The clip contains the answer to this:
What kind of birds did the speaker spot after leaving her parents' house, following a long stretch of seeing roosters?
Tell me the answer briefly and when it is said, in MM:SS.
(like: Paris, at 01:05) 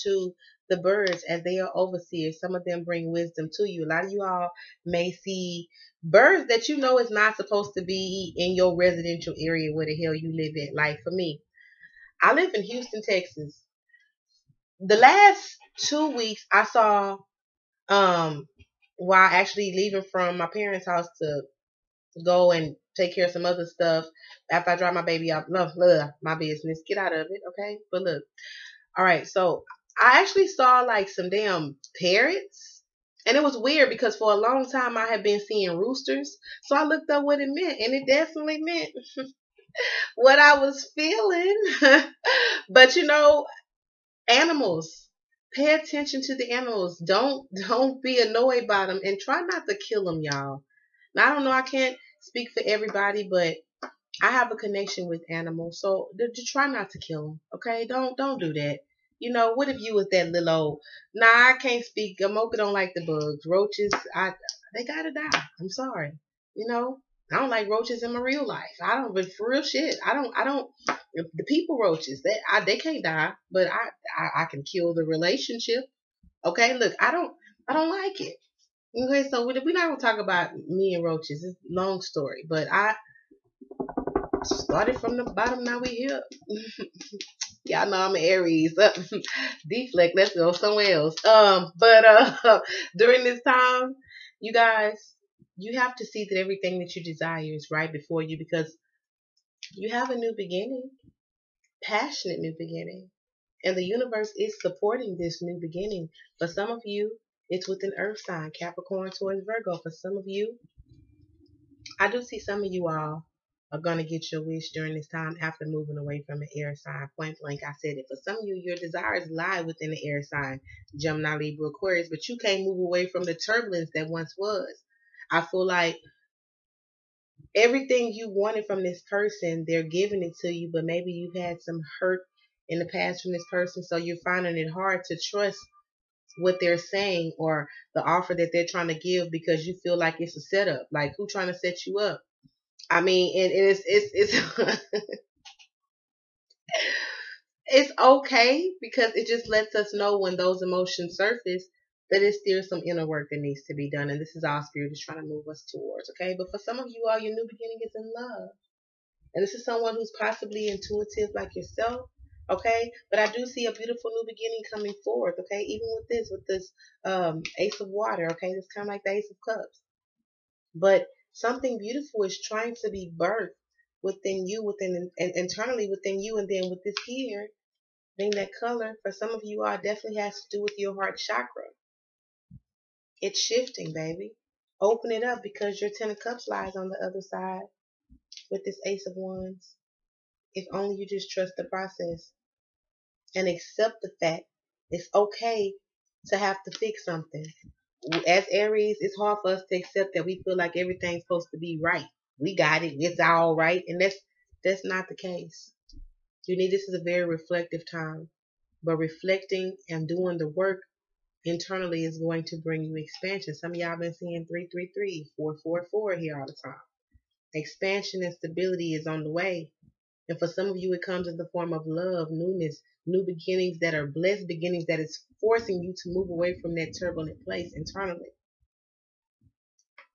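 Parrots, at 00:31.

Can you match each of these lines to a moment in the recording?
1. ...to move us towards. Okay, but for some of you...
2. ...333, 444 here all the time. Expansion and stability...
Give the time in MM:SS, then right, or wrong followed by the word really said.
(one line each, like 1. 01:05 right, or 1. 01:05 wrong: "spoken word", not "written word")
1. 02:35 right
2. 03:34 right.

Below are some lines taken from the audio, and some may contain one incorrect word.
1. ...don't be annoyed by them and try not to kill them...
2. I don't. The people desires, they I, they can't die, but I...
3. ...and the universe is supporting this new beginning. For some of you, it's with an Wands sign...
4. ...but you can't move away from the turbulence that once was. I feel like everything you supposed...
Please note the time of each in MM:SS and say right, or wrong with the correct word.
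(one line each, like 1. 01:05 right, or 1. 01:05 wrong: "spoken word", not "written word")
1. 00:47 right
2. 01:10 wrong: "roaches", not "desires"
3. 01:43 wrong: "Earth", not "Wands"
4. 02:02 wrong: "wanted", not "supposed".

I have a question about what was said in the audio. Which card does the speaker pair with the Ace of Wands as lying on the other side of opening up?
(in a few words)
Ten of Cups.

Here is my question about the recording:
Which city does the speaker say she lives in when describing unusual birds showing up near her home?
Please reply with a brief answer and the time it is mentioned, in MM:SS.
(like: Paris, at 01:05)
Houston, at 00:12.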